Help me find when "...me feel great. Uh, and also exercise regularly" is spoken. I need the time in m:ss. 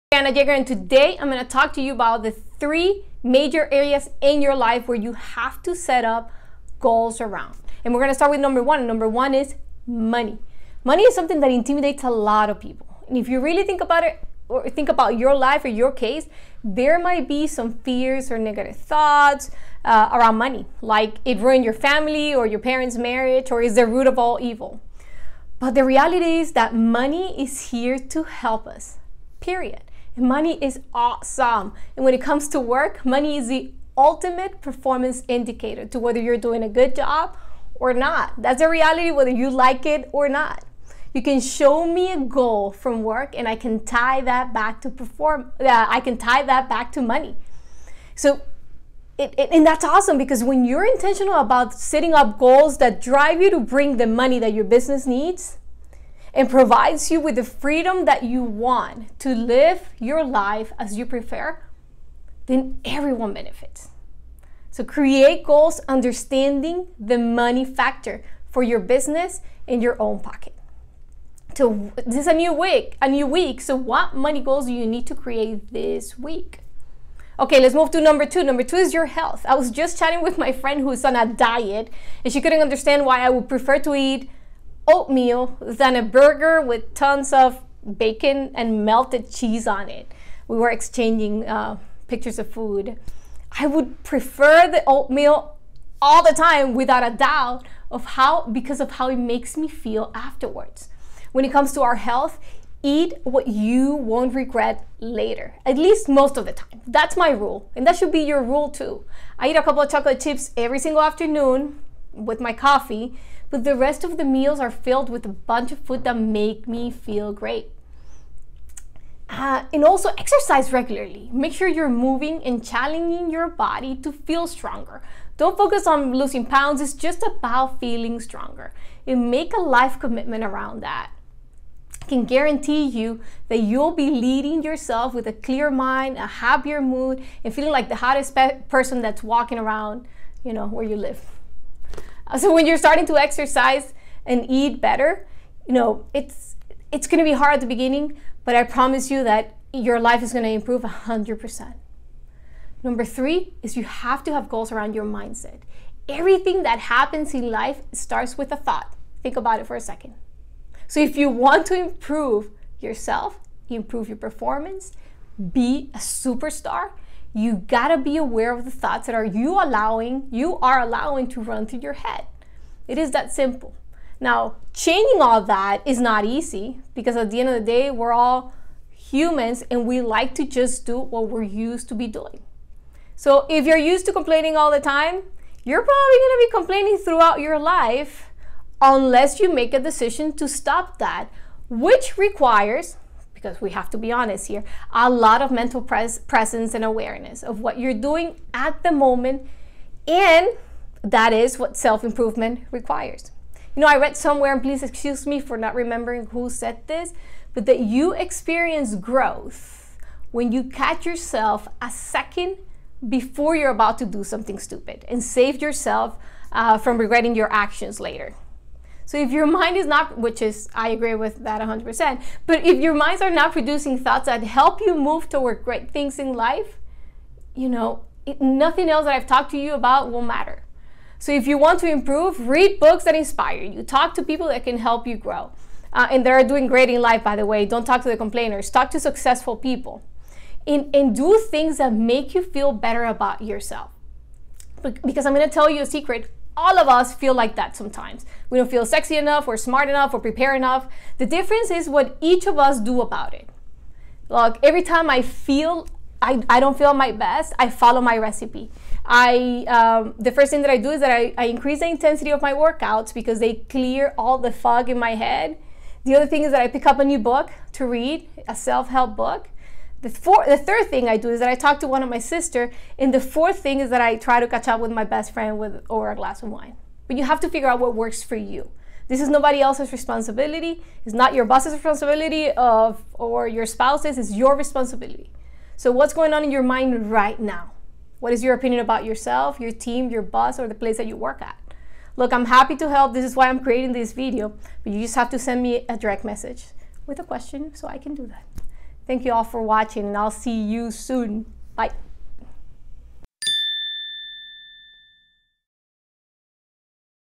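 1:56.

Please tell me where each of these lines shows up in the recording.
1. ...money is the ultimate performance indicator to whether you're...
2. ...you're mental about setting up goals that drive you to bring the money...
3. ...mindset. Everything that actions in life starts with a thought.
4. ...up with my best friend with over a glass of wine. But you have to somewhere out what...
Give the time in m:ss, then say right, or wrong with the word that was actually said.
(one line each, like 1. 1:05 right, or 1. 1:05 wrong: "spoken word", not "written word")
1. 0:33 right
2. 0:50 wrong: "intentional", not "mental"
3. 2:35 wrong: "happens", not "actions"
4. 4:34 wrong: "figure", not "somewhere".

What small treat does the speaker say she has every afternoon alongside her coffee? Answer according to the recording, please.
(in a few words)
a couple of chocolate chips.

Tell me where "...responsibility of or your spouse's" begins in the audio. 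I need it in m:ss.
4:41.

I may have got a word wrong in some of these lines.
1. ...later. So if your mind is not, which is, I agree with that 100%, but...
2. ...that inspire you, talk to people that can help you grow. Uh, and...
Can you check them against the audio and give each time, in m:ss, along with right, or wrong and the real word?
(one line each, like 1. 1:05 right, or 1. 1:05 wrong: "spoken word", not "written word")
1. 3:37 right
2. 3:53 right.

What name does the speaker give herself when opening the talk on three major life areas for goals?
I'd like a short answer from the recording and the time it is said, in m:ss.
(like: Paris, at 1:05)
Anna Jagger, at 0:00.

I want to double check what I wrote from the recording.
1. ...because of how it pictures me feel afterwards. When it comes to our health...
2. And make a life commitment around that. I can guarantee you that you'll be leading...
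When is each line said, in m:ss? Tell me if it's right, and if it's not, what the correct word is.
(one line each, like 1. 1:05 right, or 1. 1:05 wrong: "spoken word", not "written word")
1. 1:38 wrong: "makes", not "pictures"
2. 2:09 right.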